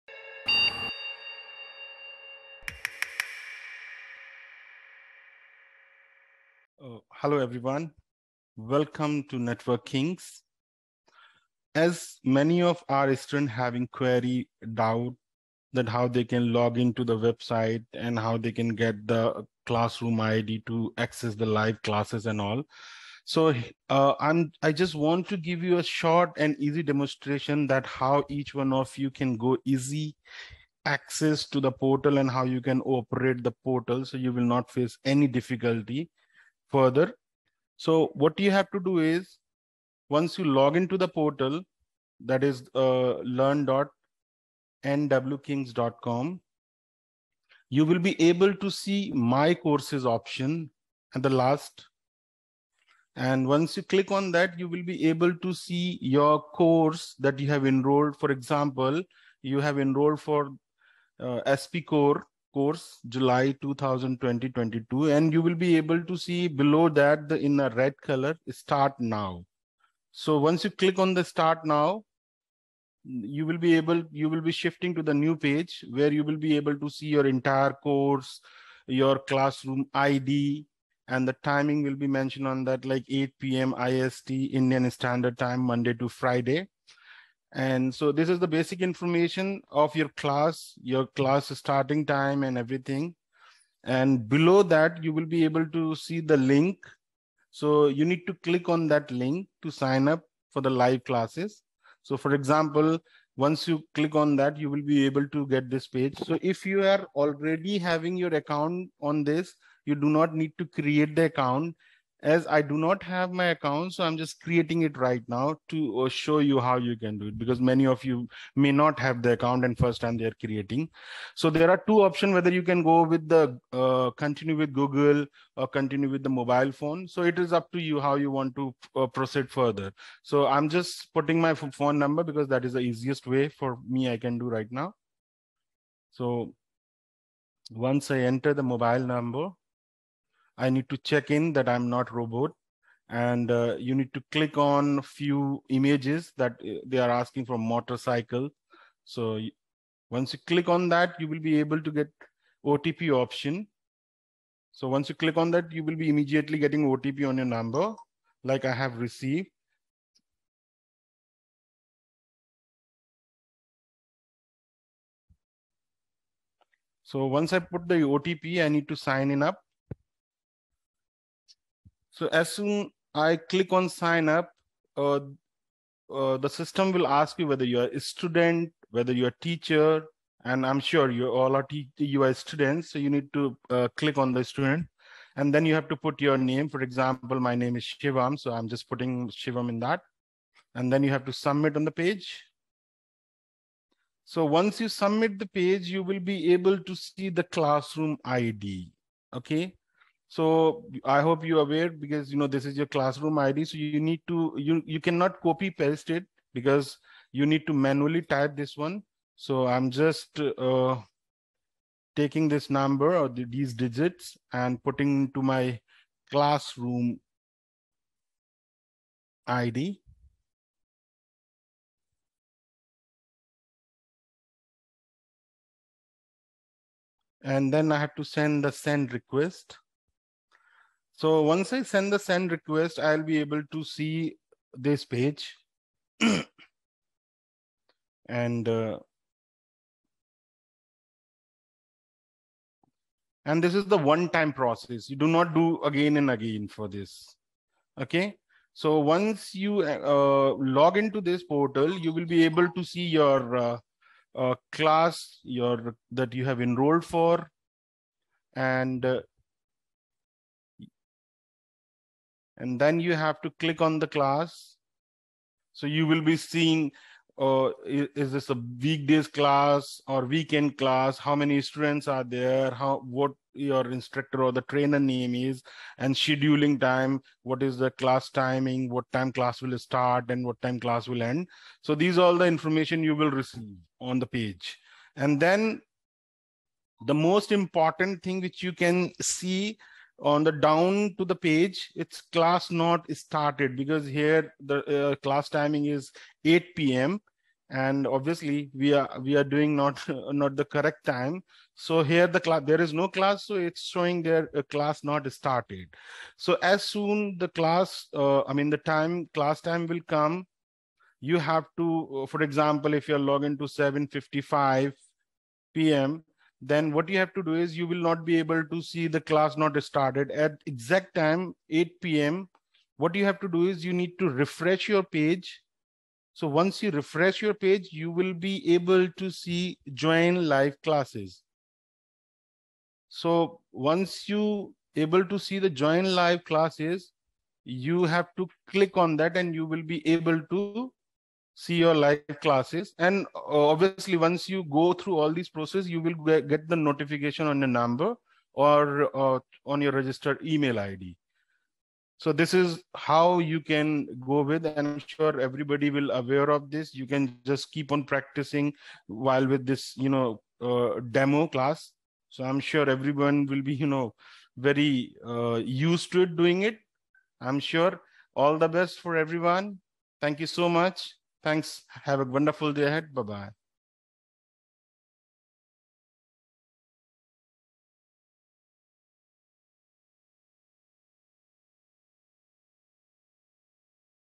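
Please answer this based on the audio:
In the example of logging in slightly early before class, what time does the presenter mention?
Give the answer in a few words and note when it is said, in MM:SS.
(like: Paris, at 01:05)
7:55 p.m., at 05:13.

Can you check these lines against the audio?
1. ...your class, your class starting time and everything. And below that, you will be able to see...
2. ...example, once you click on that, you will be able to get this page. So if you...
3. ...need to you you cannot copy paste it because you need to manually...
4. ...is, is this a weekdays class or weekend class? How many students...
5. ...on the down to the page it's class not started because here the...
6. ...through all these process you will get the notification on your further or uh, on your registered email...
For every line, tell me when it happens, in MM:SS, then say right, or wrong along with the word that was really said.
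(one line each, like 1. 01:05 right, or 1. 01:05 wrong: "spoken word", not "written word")
1. 01:29 right
2. 01:42 right
3. 03:24 right
4. 04:27 right
5. 04:50 right
6. 05:44 wrong: "number", not "further".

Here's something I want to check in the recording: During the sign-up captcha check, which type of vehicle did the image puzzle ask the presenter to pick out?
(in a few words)
Motorcycle.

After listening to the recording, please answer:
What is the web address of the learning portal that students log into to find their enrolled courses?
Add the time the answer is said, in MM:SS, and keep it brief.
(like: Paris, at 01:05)
learn.nwkings.com, at 00:43.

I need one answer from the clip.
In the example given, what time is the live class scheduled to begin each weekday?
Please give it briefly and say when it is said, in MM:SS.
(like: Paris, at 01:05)
8 p.m. IST, at 01:23.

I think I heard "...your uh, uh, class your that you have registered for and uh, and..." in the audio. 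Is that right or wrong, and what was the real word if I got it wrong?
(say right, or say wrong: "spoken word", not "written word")
wrong: "enrolled", not "registered".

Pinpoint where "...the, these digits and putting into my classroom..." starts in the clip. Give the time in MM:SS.
03:33.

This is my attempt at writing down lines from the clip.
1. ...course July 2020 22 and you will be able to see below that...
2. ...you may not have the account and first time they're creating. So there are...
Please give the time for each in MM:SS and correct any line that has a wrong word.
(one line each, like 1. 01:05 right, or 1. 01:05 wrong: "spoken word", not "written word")
1. 01:02 right
2. 01:58 right.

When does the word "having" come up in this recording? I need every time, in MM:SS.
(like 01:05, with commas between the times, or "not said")
00:13, 01:47.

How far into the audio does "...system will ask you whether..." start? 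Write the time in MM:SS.
02:56.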